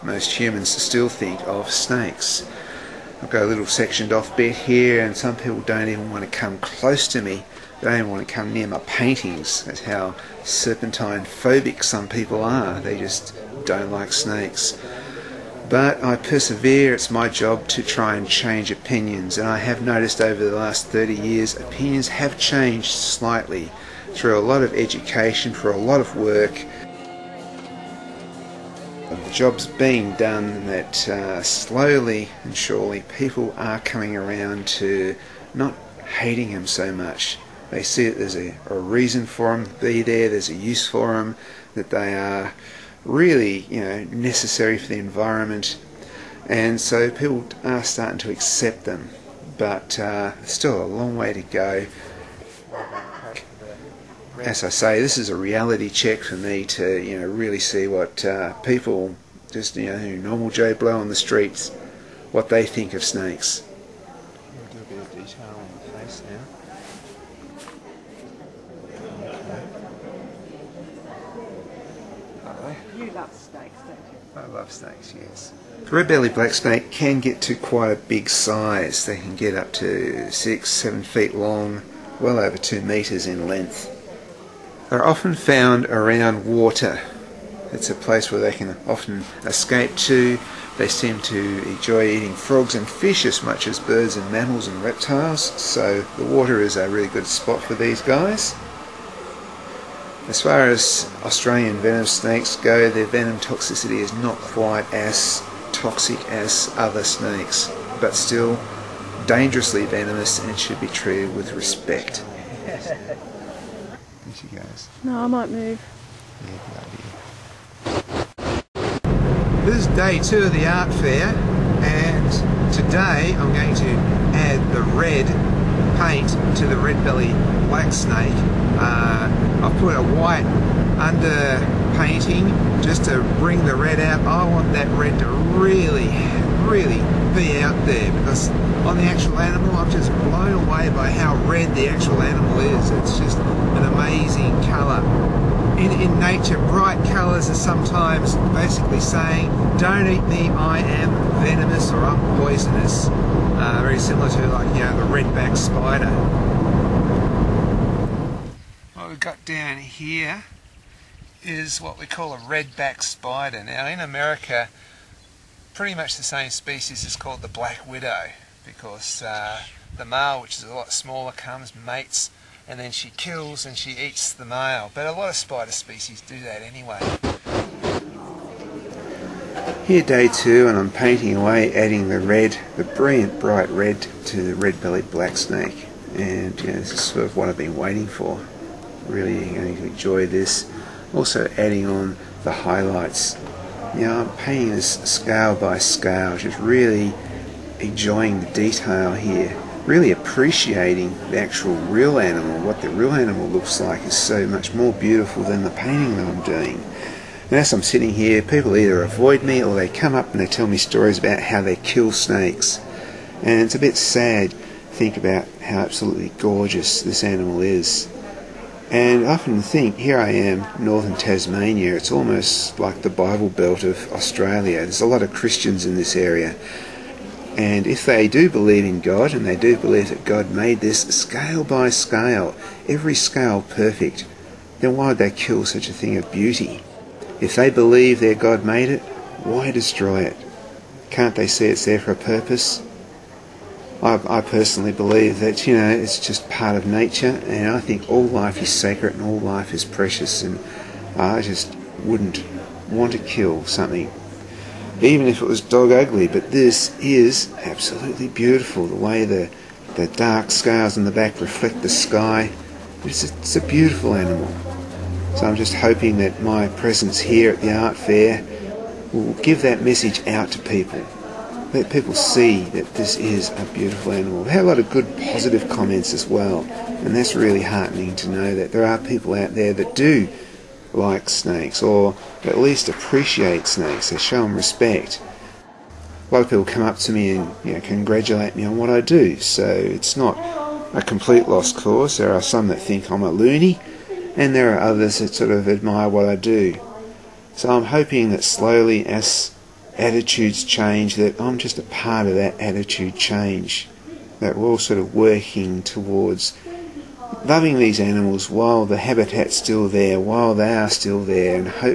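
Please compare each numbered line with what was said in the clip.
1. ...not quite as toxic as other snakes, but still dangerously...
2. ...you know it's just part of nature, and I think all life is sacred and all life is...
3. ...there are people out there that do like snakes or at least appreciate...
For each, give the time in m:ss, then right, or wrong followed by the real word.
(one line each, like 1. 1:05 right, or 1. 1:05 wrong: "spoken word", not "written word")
1. 1:44 right
2. 4:05 right
3. 4:38 right.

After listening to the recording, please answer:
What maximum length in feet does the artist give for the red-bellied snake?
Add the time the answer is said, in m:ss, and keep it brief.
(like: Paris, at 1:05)
6 or 7 feet, at 1:20.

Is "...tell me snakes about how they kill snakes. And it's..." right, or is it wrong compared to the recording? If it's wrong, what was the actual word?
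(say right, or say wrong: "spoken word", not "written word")
wrong: "stories", not "snakes".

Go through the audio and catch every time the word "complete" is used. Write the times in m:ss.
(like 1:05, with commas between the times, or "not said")
4:51.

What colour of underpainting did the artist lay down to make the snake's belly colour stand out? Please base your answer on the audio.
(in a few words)
White.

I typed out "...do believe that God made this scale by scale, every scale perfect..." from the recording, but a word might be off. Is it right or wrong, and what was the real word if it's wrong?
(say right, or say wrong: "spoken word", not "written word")
right.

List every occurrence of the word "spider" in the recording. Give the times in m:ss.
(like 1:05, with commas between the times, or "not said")
2:35, 2:43, 2:55.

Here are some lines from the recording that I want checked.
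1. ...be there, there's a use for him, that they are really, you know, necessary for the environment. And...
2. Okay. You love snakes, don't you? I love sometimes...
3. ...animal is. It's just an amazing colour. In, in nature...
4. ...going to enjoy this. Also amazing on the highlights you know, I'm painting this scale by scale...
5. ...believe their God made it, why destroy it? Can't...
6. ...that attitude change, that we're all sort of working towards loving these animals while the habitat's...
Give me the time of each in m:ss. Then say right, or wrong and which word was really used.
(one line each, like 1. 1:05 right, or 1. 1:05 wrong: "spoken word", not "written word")
1. 0:39 right
2. 1:12 wrong: "snakes", not "sometimes"
3. 2:22 right
4. 3:09 wrong: "adding", not "amazing"
5. 3:57 right
6. 5:02 right.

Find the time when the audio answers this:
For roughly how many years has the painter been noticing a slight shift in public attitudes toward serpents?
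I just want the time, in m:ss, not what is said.
0:20.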